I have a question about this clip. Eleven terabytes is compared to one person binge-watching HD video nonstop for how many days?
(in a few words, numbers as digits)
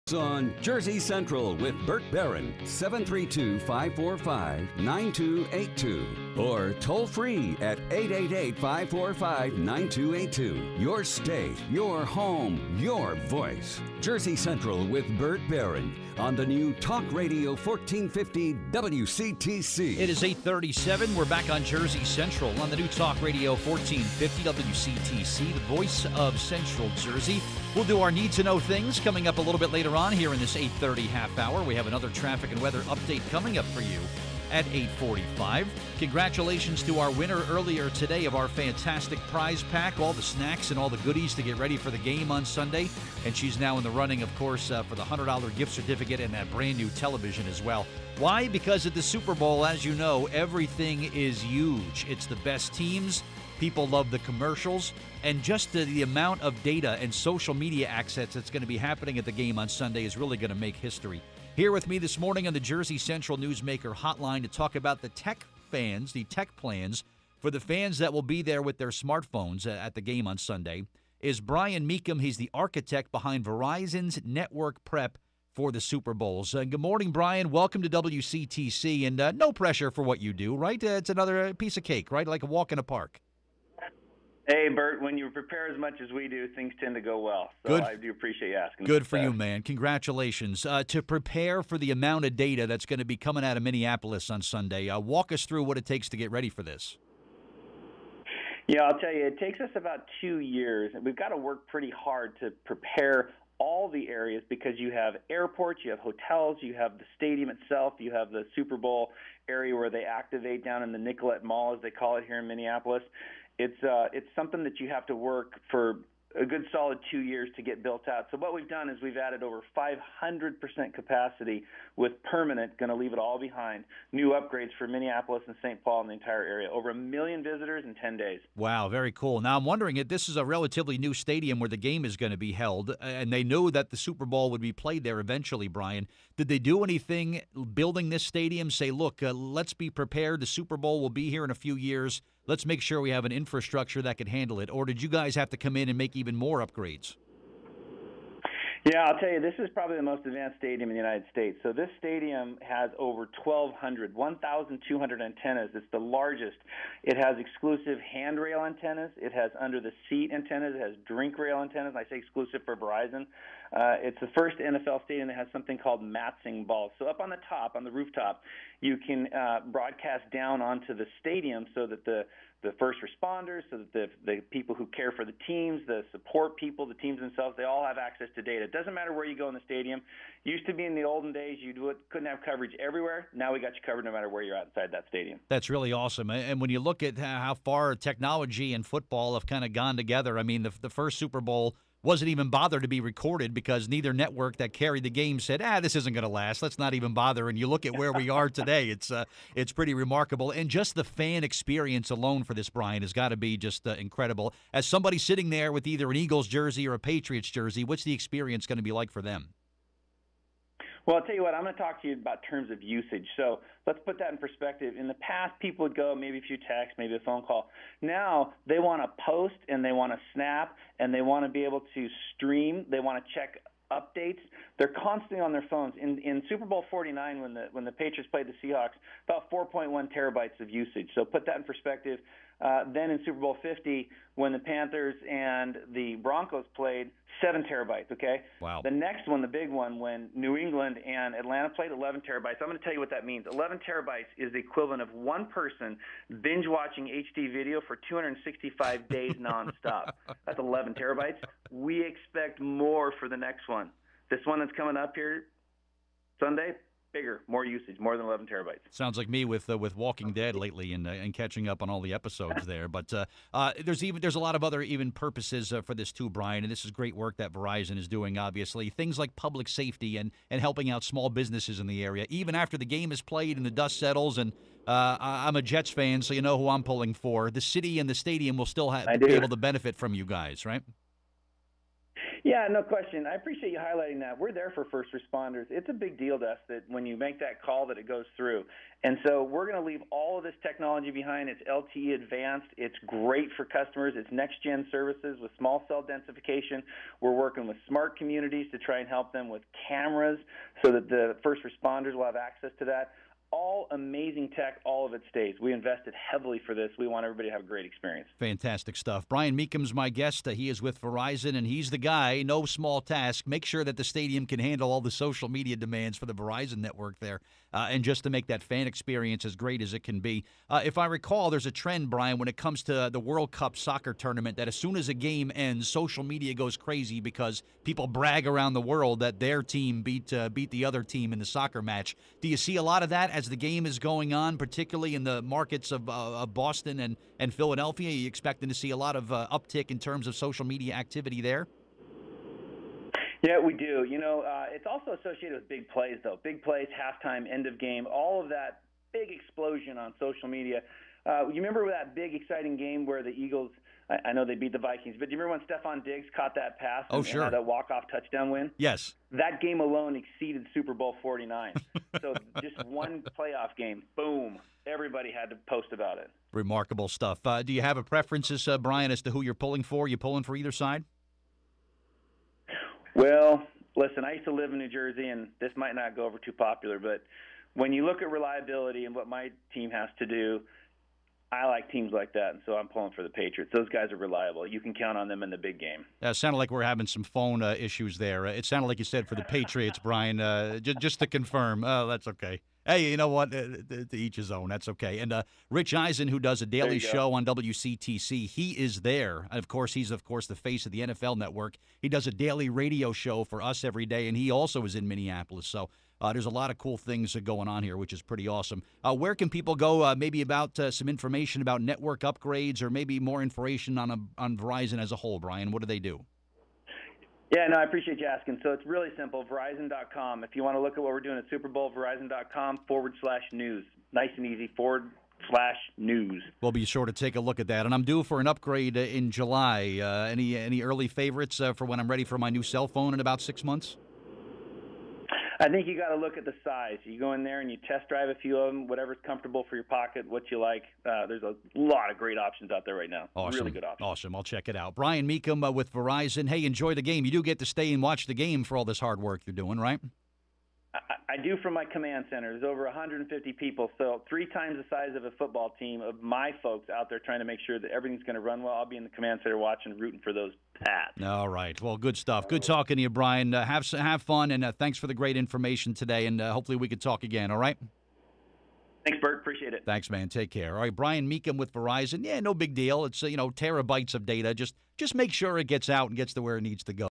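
265 days.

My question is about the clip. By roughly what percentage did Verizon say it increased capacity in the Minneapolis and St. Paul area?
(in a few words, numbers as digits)
500%.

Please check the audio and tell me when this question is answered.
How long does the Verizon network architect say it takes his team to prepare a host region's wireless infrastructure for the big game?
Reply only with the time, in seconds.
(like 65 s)
99 s.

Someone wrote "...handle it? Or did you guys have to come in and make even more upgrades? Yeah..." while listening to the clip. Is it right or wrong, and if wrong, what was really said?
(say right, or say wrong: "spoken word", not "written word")
right.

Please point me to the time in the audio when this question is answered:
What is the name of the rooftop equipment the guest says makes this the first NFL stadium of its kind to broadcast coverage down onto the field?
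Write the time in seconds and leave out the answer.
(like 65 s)
166 s.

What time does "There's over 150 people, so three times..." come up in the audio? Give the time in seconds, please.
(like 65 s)
452 s.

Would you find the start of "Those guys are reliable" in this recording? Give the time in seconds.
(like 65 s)
383 s.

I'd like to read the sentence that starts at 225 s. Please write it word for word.
In, in Super Bowl 49, when the when the Patriots played the Seahawks, about 4.1 terabytes of usage.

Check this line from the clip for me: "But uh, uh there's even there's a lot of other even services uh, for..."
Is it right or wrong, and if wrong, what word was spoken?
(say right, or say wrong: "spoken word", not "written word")
wrong: "purposes", not "services".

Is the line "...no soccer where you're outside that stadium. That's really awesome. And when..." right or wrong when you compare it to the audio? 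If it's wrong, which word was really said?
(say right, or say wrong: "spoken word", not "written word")
wrong: "matter", not "soccer".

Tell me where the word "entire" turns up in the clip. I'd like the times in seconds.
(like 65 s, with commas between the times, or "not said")
126 s.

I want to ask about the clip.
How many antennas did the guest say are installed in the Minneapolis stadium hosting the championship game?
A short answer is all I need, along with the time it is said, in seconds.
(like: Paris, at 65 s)
1,200, at 154 s.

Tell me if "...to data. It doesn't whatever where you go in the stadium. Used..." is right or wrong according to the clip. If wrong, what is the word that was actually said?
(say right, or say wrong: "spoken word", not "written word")
wrong: "matter", not "whatever".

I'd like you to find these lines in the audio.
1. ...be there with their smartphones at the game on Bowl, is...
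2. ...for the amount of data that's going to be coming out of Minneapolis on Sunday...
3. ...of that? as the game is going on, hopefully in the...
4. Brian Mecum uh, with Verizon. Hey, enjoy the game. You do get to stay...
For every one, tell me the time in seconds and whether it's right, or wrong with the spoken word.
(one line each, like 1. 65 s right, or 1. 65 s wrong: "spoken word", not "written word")
1. 68 s wrong: "Sunday", not "Bowl"
2. 91 s right
3. 333 s wrong: "particularly", not "hopefully"
4. 444 s right.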